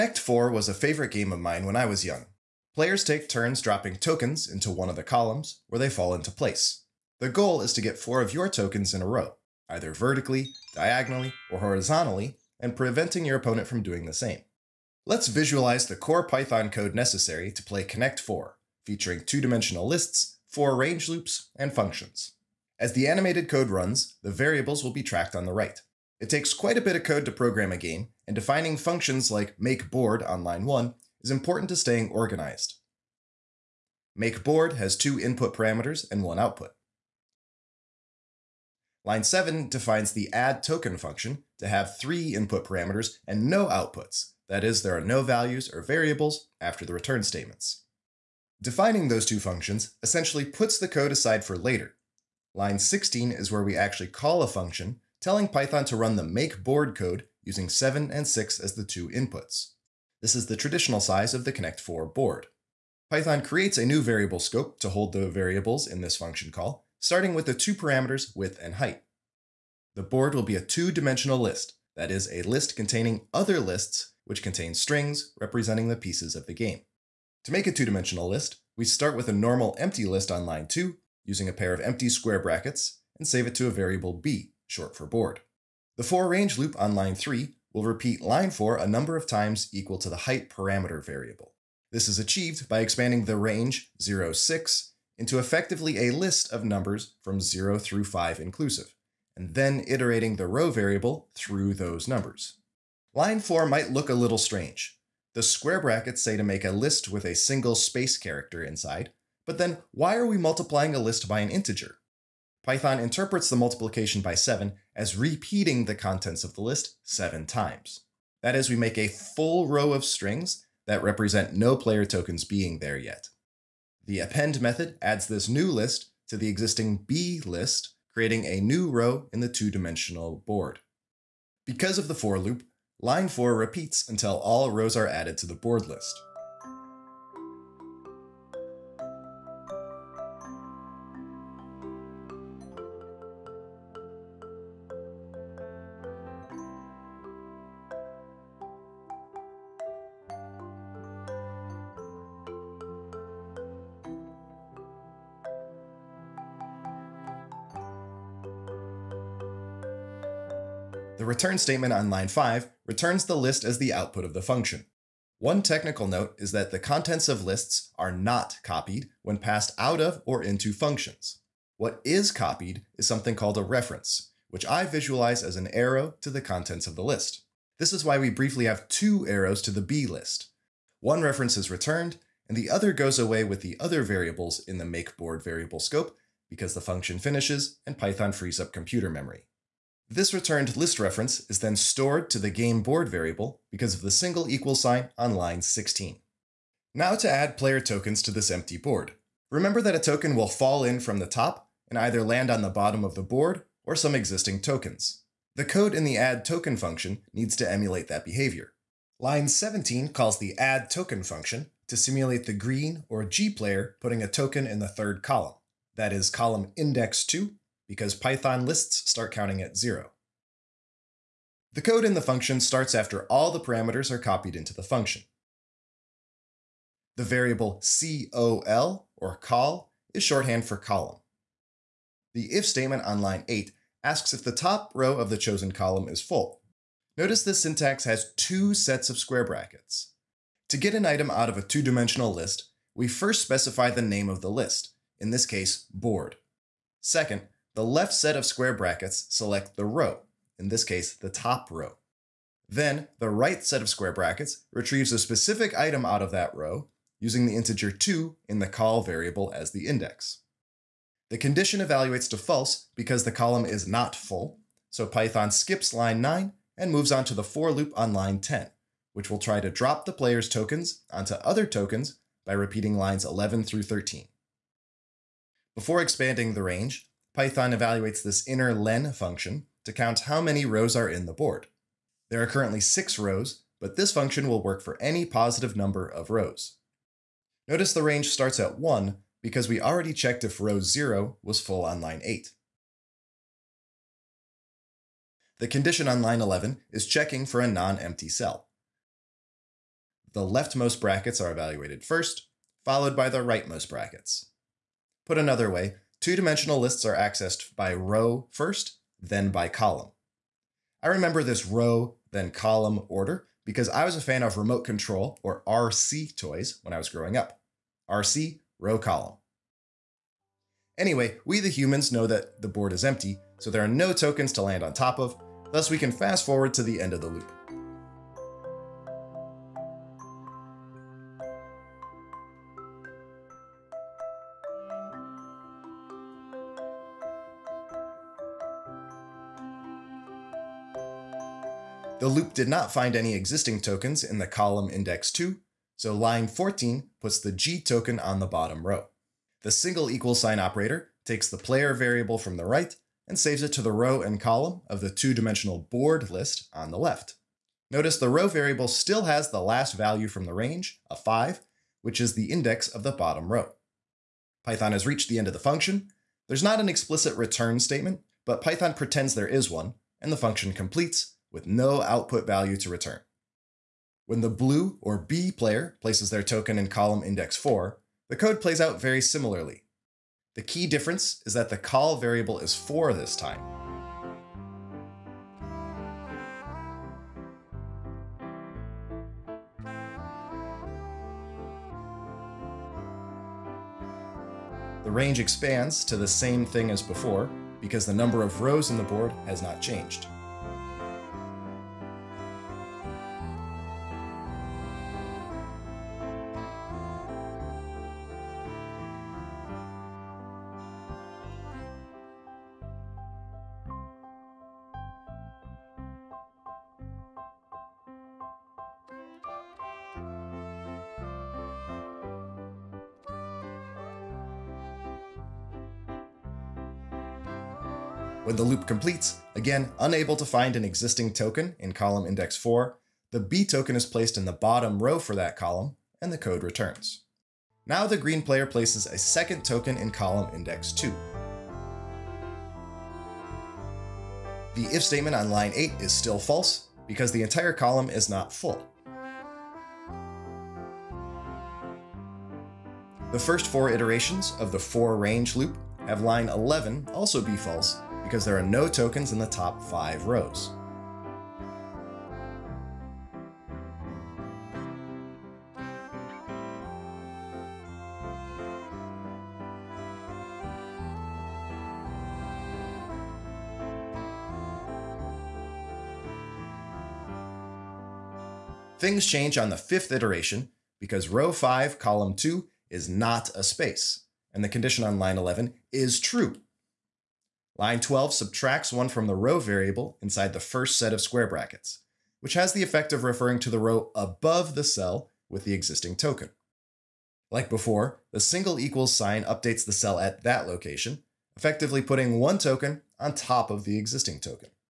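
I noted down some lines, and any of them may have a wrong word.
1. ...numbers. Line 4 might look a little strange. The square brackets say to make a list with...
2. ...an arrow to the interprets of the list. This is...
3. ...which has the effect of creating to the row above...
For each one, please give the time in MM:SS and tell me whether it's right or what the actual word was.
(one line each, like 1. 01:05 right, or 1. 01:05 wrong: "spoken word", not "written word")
1. 01:42 right
2. 02:55 wrong: "contents", not "interprets"
3. 08:12 wrong: "referring", not "creating".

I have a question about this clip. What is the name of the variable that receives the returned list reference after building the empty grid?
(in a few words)
game board.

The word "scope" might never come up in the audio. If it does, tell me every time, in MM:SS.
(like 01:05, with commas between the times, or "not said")
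01:04, 03:05.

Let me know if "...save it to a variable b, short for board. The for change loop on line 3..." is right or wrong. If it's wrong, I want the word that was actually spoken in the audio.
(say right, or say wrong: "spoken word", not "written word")
wrong: "range", not "change".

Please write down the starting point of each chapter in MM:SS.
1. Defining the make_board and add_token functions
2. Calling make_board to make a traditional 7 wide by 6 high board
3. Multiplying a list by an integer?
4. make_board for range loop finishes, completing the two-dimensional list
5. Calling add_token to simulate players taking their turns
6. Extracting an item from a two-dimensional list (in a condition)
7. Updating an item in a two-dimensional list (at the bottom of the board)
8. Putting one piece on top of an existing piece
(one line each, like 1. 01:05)
1. 00:25
2. 00:49
3. 01:40
4. 02:39
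5. 03:16
6. 03:50
7. 05:40
8. 07:58.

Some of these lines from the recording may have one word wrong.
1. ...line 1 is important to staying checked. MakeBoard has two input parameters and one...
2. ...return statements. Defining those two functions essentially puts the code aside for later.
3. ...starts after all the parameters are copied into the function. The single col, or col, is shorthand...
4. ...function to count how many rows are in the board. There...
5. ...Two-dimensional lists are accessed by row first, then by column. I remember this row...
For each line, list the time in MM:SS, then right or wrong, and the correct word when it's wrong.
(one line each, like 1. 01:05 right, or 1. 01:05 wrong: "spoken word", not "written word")
1. 00:30 wrong: "organized", not "checked"
2. 00:46 right
3. 03:42 wrong: "variable", not "single"
4. 04:39 right
5. 05:06 right.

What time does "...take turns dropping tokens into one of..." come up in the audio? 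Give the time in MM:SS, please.
00:03.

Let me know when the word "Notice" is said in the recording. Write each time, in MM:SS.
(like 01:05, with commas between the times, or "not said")
03:57, 04:47, 05:57.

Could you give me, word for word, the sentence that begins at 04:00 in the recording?
To get an item out of a two-dimensional list, we first specify the name of the list, in this case, board.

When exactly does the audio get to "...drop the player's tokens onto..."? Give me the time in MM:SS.
04:29.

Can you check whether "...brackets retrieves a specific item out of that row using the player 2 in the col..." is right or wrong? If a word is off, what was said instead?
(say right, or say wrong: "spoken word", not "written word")
wrong: "integer", not "player".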